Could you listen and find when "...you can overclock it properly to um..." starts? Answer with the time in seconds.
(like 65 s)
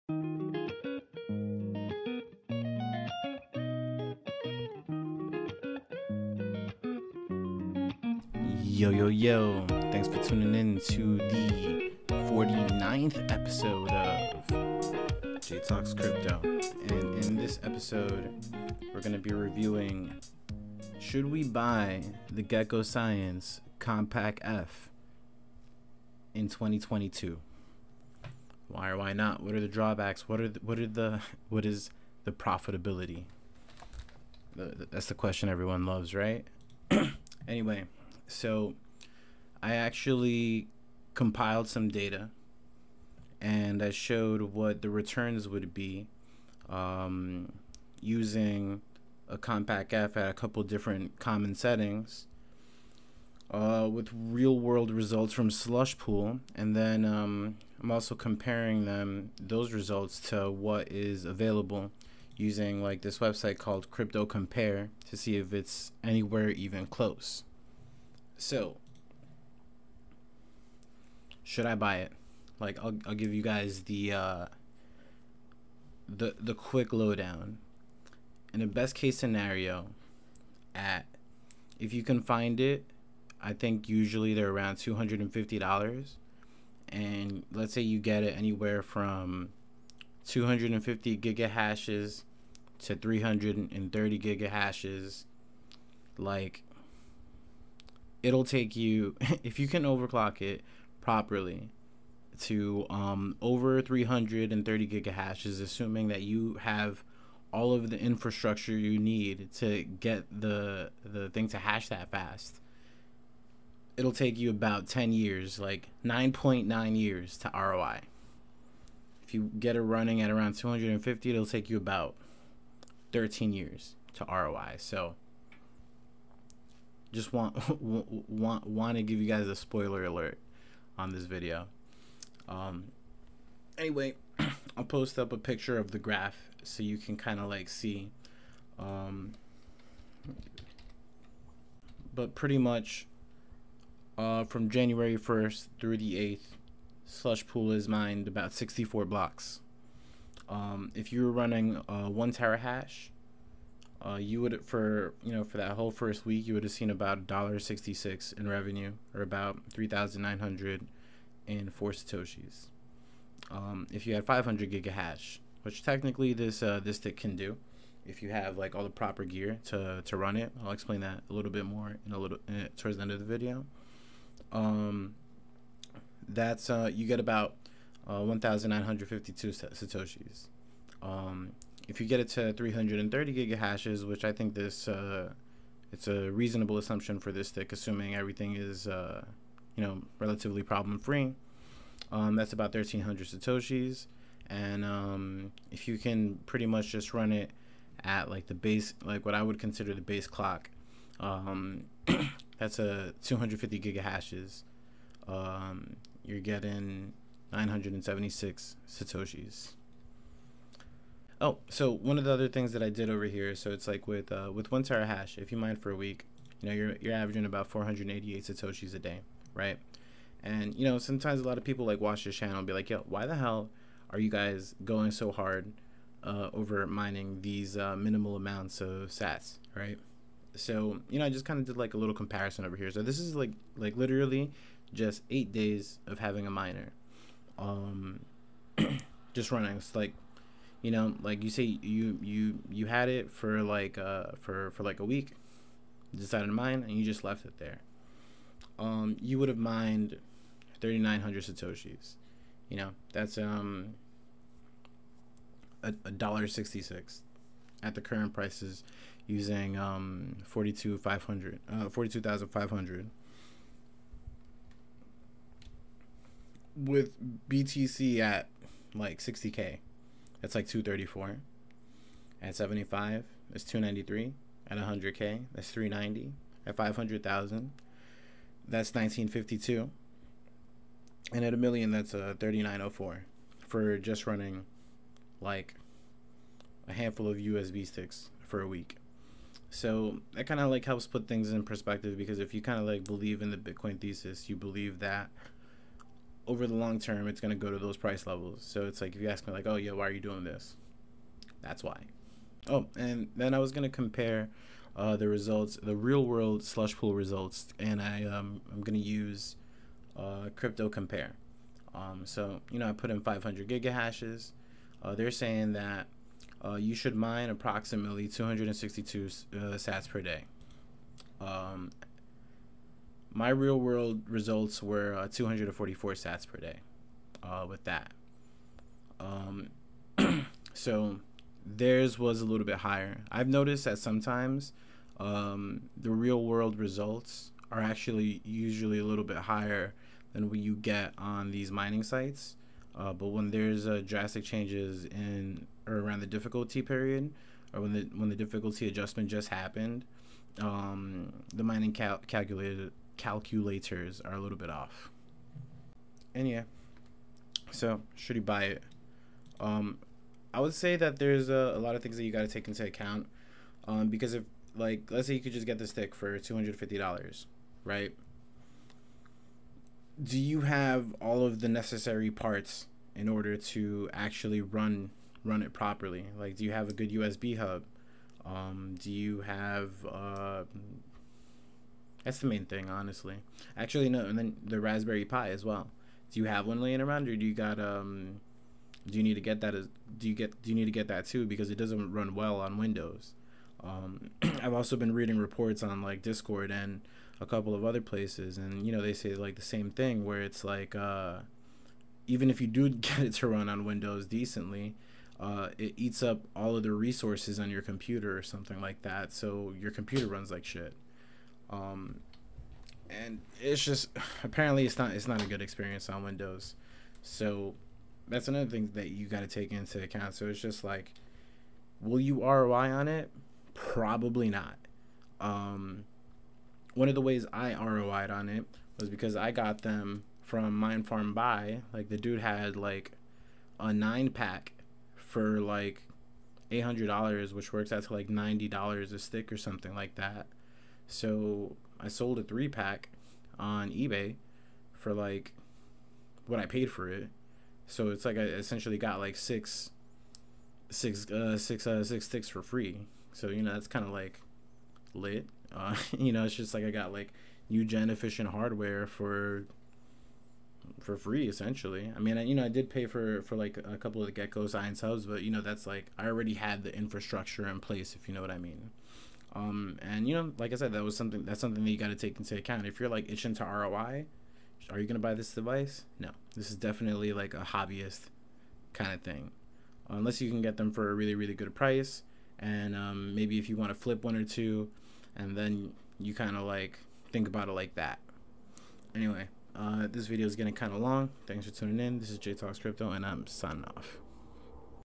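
99 s.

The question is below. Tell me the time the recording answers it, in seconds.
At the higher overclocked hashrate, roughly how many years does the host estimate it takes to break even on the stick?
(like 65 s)
116 s.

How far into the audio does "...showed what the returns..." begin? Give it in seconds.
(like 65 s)
43 s.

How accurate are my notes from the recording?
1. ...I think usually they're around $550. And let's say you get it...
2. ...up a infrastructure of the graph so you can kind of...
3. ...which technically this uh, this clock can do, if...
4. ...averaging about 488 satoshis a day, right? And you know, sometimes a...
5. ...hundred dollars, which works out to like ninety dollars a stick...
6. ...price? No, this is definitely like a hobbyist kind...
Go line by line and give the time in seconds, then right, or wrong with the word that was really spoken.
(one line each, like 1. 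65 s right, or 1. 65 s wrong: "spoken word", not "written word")
1. 83 s wrong: "250", not "550"
2. 135 s wrong: "picture", not "infrastructure"
3. 165 s wrong: "stick", not "clock"
4. 217 s right
5. 436 s right
6. 475 s wrong: "device", not "price".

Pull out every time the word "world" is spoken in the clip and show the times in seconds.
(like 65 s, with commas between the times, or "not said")
54 s, 306 s, 323 s, 336 s.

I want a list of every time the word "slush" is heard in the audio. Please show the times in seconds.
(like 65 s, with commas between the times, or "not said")
55 s, 147 s, 306 s.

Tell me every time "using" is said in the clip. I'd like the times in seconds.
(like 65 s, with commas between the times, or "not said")
47 s, 62 s, 259 s.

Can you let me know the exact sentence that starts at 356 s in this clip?
And yeah, so should you buy it?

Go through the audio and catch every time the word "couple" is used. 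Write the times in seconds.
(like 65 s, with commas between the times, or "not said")
50 s, 397 s, 463 s.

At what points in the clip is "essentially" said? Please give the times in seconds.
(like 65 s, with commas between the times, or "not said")
448 s, 461 s.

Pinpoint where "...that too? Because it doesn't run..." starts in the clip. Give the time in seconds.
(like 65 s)
391 s.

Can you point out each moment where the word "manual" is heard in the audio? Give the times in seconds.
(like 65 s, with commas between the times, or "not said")
not said.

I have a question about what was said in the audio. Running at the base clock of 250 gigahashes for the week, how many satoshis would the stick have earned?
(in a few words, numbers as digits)
976.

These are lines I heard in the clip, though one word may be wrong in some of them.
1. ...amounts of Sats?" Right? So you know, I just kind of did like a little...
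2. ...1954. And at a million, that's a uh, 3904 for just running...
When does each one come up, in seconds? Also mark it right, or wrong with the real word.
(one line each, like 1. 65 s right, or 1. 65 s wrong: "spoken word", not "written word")
1. 228 s right
2. 278 s wrong: "1952", not "1954".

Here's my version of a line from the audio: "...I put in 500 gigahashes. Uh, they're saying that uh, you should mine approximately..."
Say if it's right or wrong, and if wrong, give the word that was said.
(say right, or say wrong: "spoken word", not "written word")
right.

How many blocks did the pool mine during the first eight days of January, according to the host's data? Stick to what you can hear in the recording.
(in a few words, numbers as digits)
64.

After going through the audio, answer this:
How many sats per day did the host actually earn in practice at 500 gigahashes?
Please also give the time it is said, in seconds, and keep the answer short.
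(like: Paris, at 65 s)
244, at 325 s.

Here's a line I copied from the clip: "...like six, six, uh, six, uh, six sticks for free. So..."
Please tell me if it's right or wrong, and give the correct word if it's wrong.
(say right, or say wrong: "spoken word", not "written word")
right.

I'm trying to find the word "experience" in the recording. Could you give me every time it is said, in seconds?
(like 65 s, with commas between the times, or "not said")
415 s.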